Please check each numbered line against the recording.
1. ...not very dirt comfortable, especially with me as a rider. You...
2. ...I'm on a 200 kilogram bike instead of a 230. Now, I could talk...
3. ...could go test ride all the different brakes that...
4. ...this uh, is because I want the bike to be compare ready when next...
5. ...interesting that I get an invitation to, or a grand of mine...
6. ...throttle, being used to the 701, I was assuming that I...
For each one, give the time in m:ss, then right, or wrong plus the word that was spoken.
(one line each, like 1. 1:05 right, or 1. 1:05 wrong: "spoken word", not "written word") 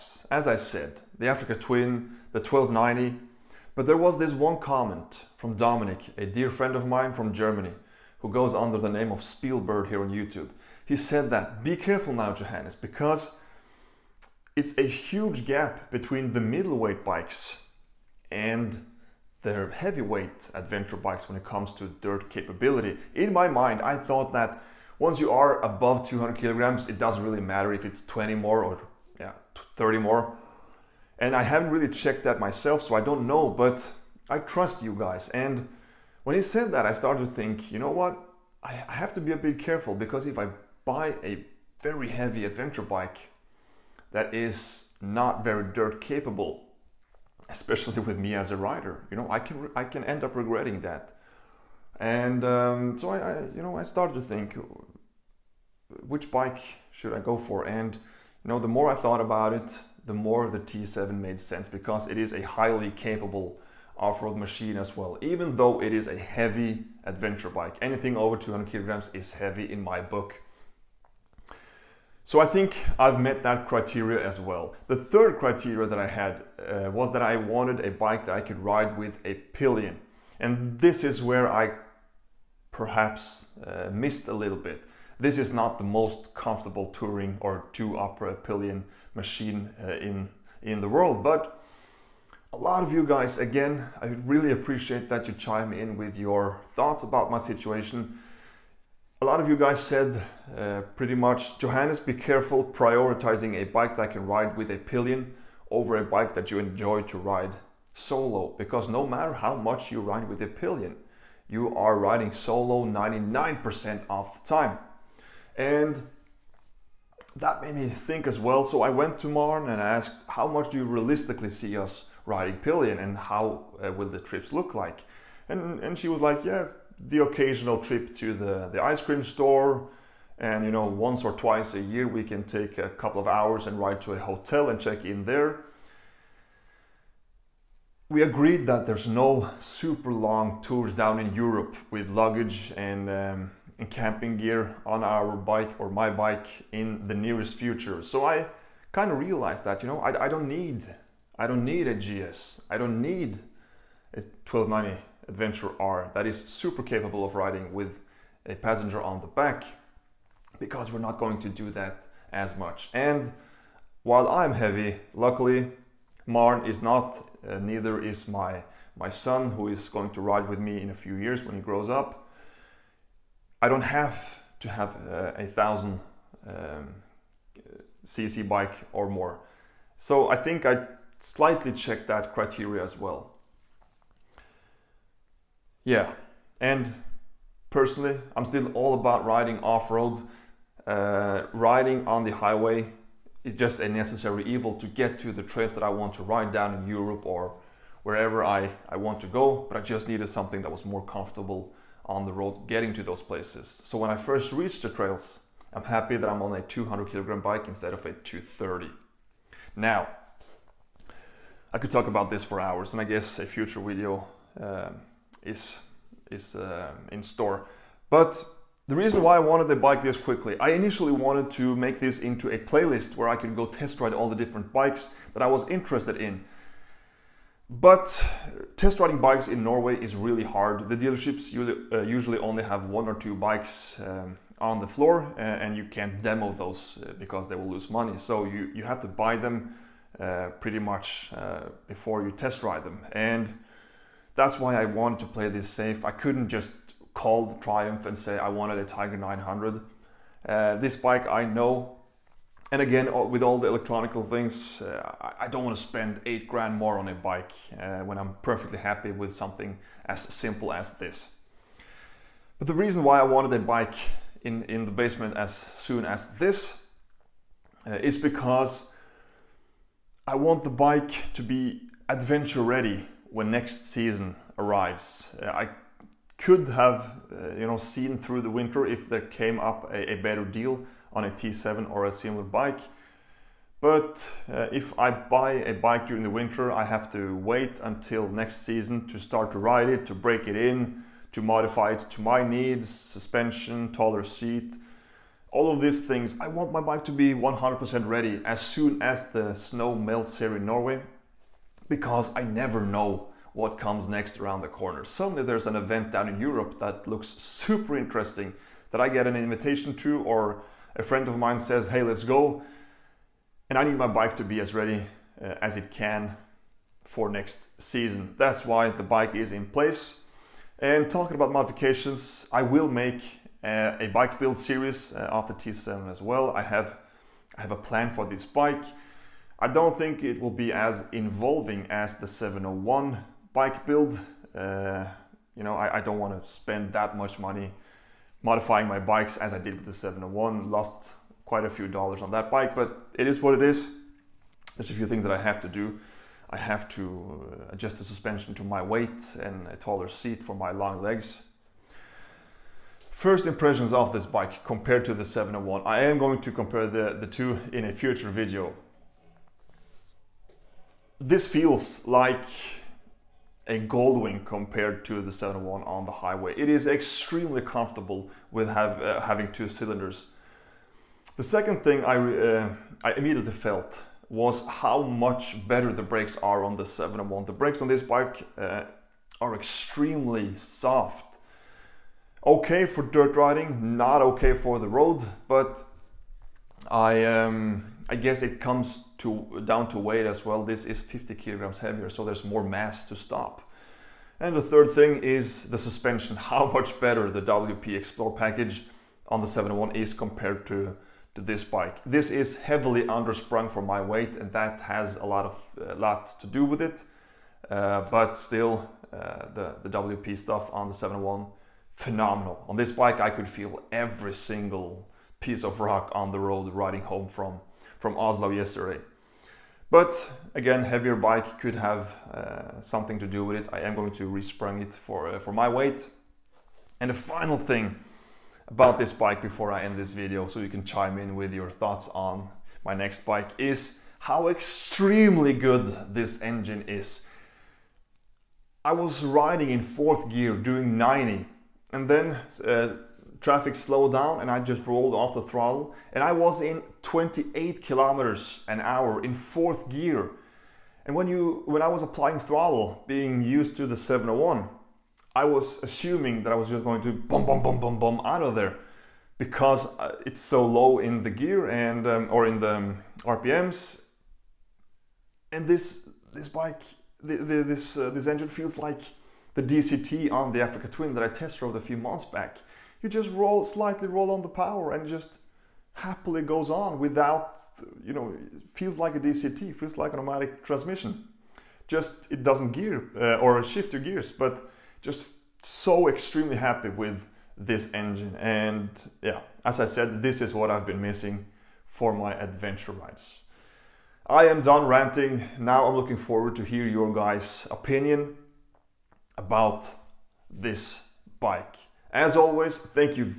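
1. 0:44 wrong: "capable", not "comfortable"
2. 3:26 right
3. 3:43 wrong: "bikes", not "brakes"
4. 4:26 wrong: "adventure", not "compare"
5. 5:07 wrong: "friend", not "grand"
6. 7:32 right.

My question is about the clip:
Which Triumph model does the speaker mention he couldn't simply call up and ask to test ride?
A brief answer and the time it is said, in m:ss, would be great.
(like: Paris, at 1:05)
Tiger 900, at 4:08.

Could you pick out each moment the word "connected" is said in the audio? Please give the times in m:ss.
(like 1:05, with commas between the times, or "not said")
not said.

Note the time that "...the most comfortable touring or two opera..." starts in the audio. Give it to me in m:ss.
1:25.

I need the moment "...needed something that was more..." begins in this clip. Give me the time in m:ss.
3:20.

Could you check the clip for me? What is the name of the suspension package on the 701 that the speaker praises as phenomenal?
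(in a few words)
WP Xplor.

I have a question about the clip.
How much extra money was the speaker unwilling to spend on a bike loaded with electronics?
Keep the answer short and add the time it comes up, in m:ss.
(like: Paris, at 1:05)
8 grand, at 4:16.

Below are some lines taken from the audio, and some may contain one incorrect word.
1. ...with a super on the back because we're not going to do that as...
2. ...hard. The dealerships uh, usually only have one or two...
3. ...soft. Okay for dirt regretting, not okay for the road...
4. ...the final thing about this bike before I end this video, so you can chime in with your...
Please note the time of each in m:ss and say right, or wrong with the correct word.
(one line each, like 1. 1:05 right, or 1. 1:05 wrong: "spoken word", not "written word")
1. 2:37 wrong: "passenger", not "super"
2. 3:50 right
3. 6:20 wrong: "riding", not "regretting"
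4. 7:07 right.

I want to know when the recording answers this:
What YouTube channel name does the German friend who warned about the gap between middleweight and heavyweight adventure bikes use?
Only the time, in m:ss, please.
0:09.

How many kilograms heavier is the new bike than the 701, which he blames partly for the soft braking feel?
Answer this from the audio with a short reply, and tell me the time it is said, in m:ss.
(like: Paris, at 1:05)
50, at 6:31.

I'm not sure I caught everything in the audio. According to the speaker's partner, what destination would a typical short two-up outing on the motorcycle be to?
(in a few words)
the ice cream store.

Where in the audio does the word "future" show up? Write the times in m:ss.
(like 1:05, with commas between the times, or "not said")
2:27, 3:33, 5:57.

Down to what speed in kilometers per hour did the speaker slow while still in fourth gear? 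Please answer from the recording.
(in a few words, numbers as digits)
28.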